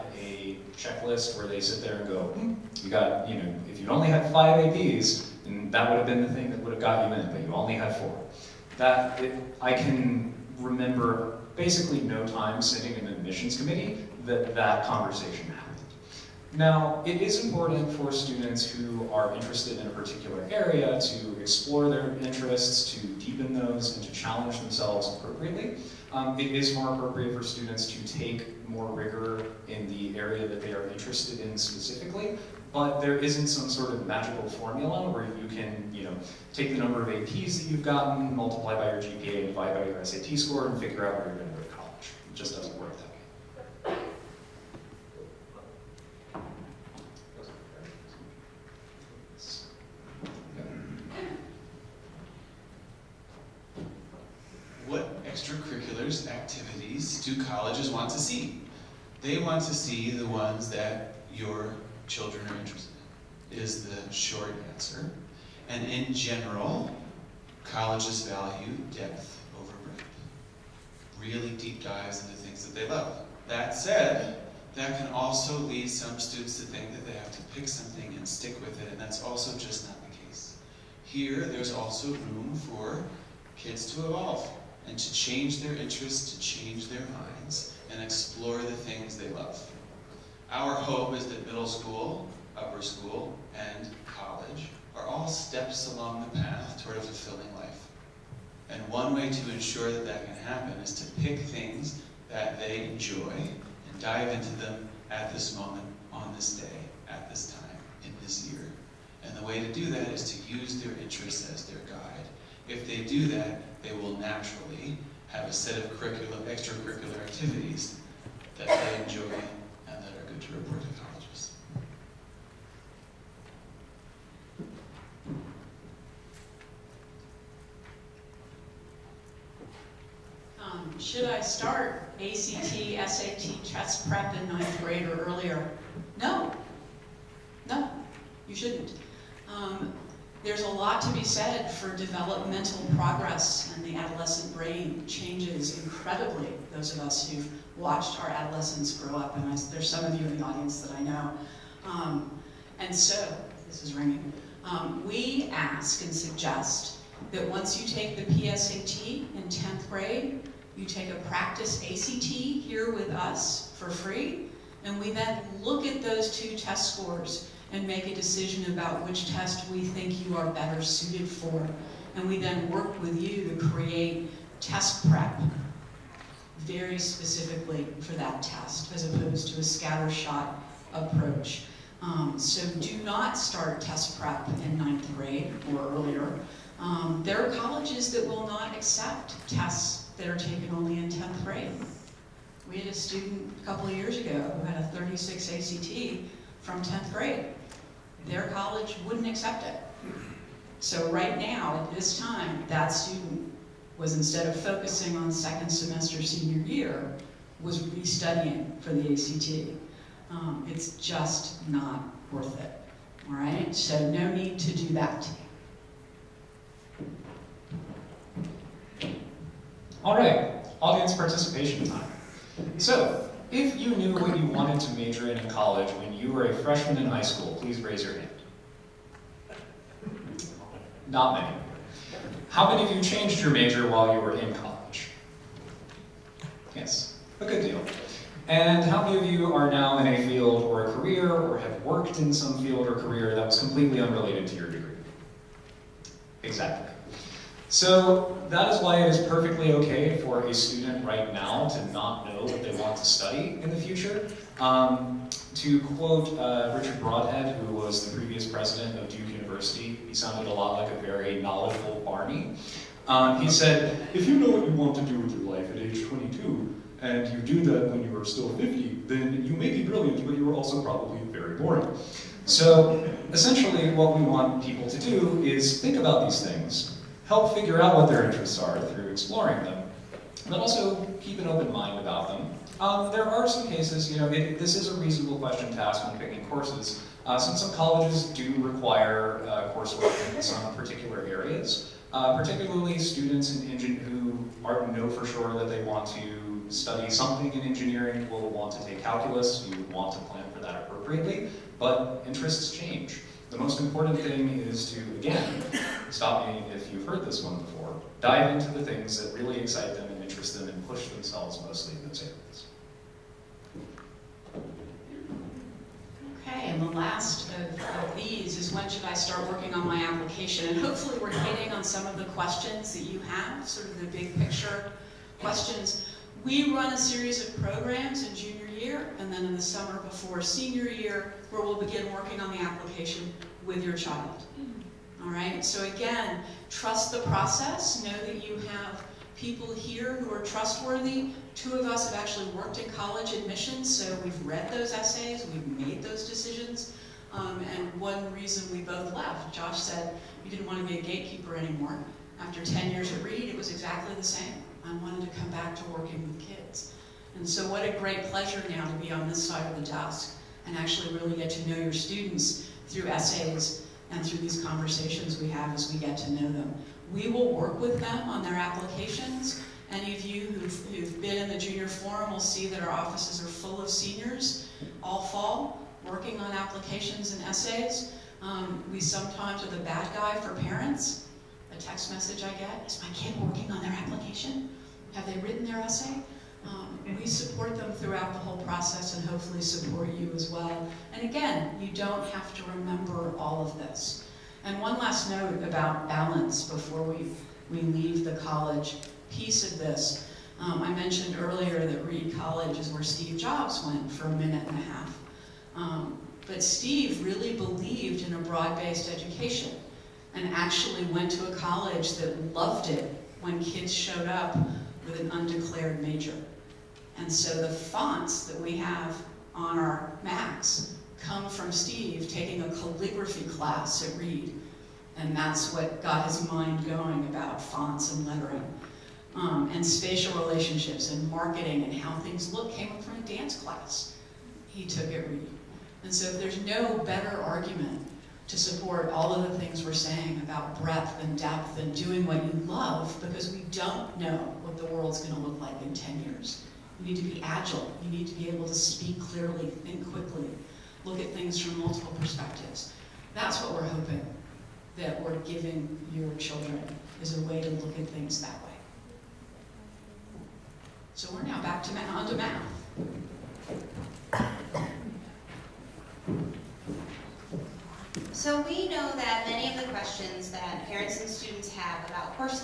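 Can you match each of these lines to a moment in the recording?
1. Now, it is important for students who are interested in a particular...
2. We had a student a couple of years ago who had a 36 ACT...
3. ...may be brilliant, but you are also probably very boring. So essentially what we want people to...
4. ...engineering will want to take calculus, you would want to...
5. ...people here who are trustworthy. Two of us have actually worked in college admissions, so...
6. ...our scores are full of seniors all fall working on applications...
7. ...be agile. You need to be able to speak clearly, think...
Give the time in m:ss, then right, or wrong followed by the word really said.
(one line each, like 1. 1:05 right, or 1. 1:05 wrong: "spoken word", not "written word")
1. 0:16 right
2. 3:12 right
3. 4:29 right
4. 4:57 right
5. 5:39 right
6. 6:12 wrong: "offices", not "scores"
7. 7:27 right.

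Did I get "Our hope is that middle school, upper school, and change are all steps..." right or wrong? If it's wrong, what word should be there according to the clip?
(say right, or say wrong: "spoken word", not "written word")
wrong: "college", not "change".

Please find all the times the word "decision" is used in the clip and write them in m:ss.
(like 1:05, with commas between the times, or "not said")
2:48, 5:46.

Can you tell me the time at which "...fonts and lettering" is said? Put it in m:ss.
7:07.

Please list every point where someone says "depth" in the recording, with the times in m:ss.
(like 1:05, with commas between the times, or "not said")
1:08, 7:21.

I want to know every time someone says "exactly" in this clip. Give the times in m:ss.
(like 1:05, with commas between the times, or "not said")
4:06, 5:53.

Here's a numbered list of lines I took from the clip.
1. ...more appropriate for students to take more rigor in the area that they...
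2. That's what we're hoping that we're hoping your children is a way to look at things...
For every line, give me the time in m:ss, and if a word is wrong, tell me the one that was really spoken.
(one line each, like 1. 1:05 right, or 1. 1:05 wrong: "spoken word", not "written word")
1. 0:26 right
2. 7:33 wrong: "giving", not "hoping".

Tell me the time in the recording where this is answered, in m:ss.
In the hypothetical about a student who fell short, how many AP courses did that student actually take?
0:07.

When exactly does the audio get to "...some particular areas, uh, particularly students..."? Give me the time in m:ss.
4:50.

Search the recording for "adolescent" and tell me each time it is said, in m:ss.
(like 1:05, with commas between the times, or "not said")
2:23, 2:28.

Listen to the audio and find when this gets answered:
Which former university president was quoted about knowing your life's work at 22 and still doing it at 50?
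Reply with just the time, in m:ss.
4:16.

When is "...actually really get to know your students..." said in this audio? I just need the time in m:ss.
6:00.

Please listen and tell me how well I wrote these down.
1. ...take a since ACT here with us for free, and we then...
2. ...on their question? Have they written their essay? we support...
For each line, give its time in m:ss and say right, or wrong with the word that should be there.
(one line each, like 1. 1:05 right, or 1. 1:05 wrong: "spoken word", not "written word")
1. 2:40 wrong: "practice", not "since"
2. 6:23 wrong: "application", not "question".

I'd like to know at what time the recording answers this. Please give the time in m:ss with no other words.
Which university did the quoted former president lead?
4:19.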